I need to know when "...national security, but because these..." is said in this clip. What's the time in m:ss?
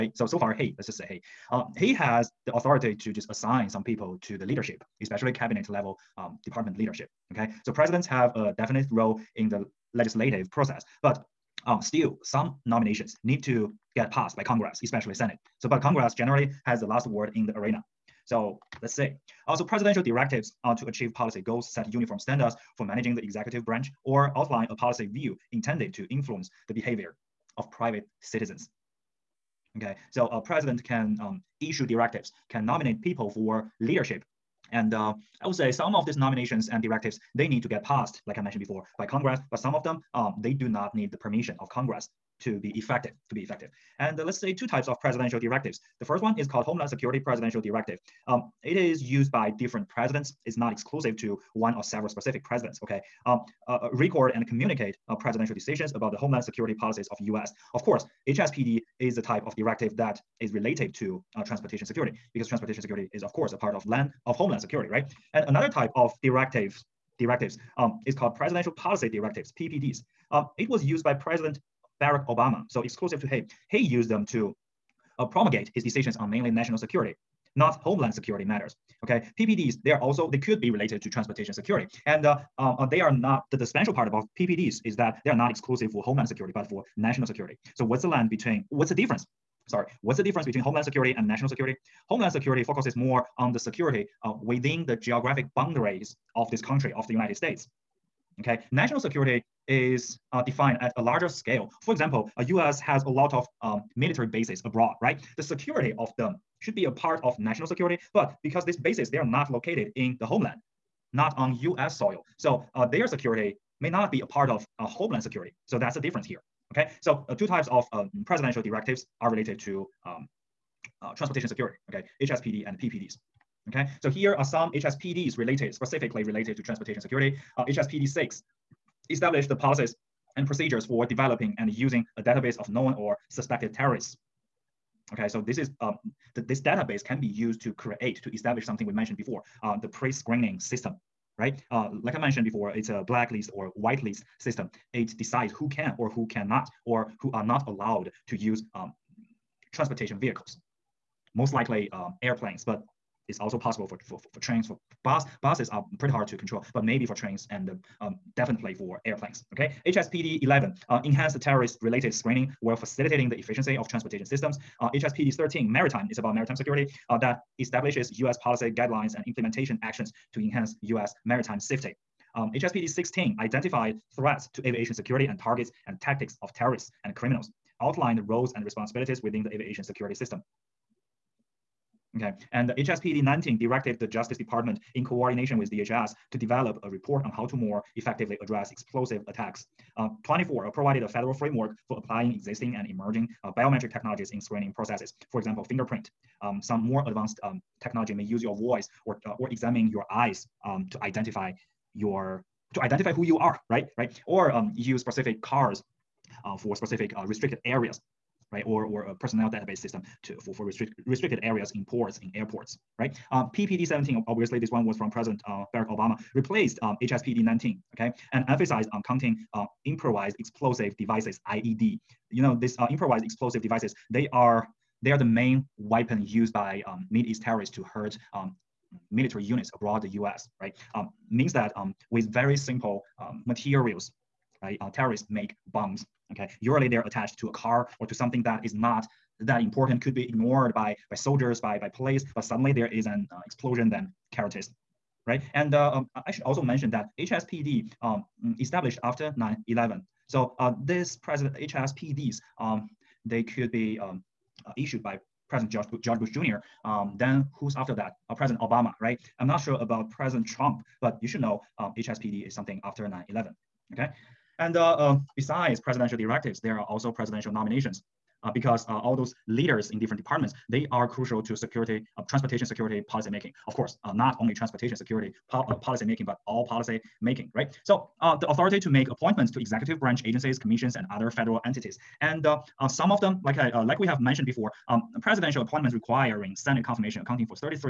1:47.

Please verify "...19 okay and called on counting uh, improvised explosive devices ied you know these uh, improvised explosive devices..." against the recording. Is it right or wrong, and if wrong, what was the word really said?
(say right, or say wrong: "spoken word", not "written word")
wrong: "emphasized", not "called".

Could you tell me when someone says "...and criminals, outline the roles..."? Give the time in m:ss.
2:57.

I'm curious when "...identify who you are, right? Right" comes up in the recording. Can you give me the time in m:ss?
3:22.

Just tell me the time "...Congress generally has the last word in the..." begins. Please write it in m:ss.
0:15.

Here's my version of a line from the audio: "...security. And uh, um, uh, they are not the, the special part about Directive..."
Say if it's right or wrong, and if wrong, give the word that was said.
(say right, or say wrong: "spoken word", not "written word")
wrong: "PPDs", not "Directive".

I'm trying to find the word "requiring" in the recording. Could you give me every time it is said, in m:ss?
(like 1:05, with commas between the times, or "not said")
4:45.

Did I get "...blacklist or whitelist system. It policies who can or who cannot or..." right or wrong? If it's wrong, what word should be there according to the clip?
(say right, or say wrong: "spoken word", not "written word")
wrong: "decides", not "policies".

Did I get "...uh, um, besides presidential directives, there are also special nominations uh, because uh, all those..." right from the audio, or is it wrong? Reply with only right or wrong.
wrong.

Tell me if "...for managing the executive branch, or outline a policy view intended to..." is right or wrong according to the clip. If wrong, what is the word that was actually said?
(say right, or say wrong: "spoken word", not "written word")
right.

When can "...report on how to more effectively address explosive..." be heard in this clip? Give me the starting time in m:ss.
3:06.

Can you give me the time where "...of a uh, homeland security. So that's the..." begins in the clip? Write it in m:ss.
1:54.